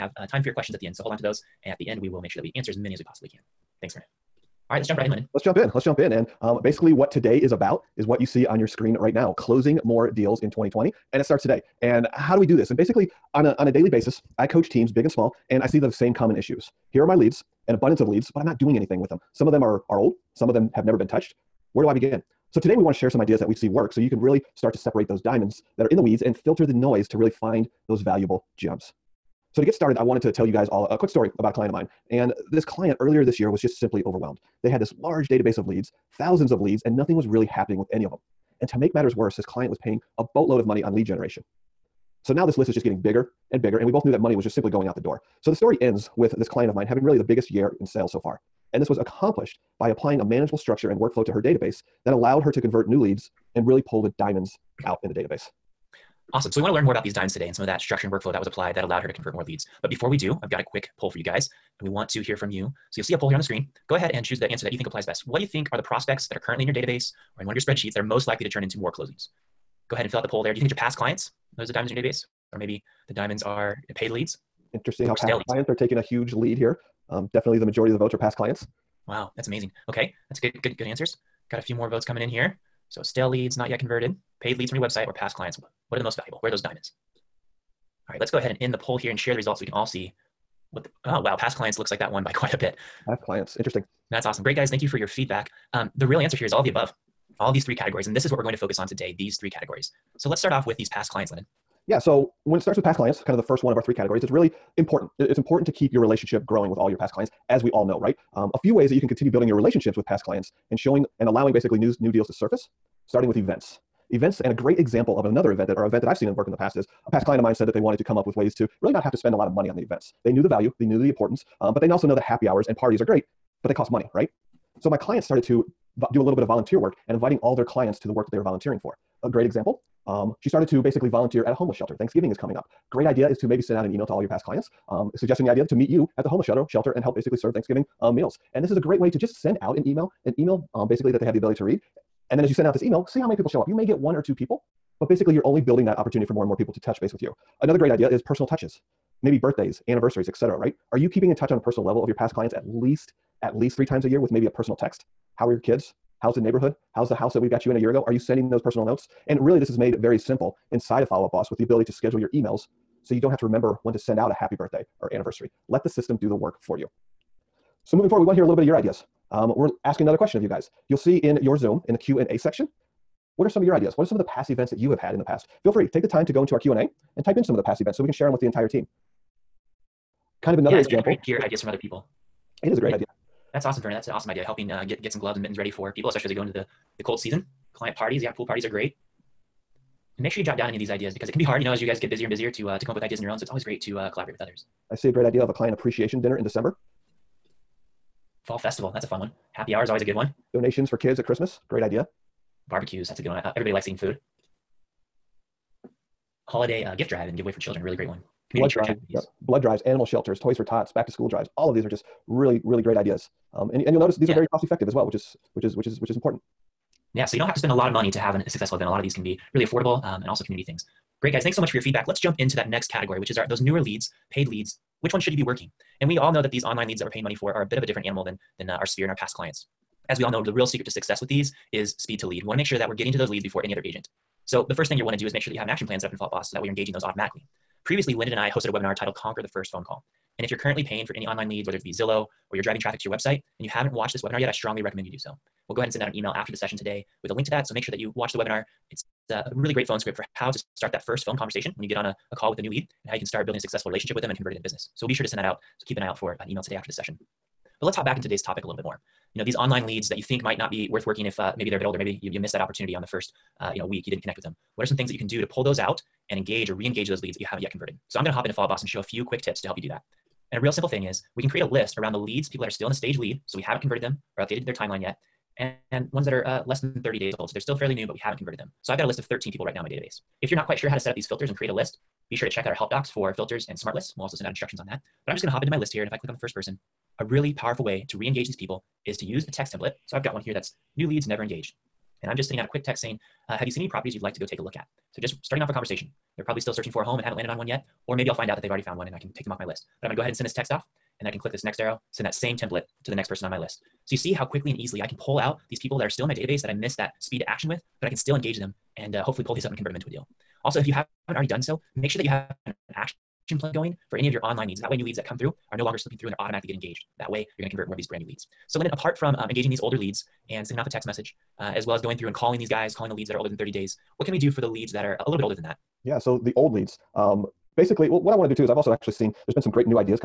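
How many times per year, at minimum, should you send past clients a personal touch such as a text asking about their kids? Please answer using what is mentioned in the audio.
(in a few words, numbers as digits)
3.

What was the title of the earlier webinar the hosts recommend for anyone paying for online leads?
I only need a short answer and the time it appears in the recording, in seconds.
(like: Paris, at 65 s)
Conquer the First Phone Call, at 239 s.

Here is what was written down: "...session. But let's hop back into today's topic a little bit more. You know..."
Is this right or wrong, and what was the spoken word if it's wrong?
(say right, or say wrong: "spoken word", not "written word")
right.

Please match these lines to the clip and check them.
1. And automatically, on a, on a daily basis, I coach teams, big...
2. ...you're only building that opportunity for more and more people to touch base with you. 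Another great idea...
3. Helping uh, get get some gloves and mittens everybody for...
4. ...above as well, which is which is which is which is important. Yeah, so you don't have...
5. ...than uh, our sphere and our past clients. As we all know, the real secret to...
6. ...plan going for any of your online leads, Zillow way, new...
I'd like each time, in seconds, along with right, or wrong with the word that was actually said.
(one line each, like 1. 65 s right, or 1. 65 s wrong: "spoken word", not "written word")
1. 12 s wrong: "basically", not "automatically"
2. 145 s right
3. 184 s wrong: "ready", not "everybody"
4. 214 s wrong: "effective", not "above"
5. 228 s right
6. 313 s wrong: "That", not "Zillow".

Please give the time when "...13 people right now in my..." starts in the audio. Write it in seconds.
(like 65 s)
279 s.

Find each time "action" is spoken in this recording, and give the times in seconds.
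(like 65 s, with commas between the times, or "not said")
235 s, 307 s, 312 s.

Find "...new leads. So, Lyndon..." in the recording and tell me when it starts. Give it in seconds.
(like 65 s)
318 s.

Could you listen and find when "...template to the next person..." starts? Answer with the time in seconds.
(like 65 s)
302 s.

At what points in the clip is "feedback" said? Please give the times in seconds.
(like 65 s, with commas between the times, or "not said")
95 s, 221 s.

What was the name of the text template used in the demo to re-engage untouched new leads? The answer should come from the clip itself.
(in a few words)
new leads never engaged.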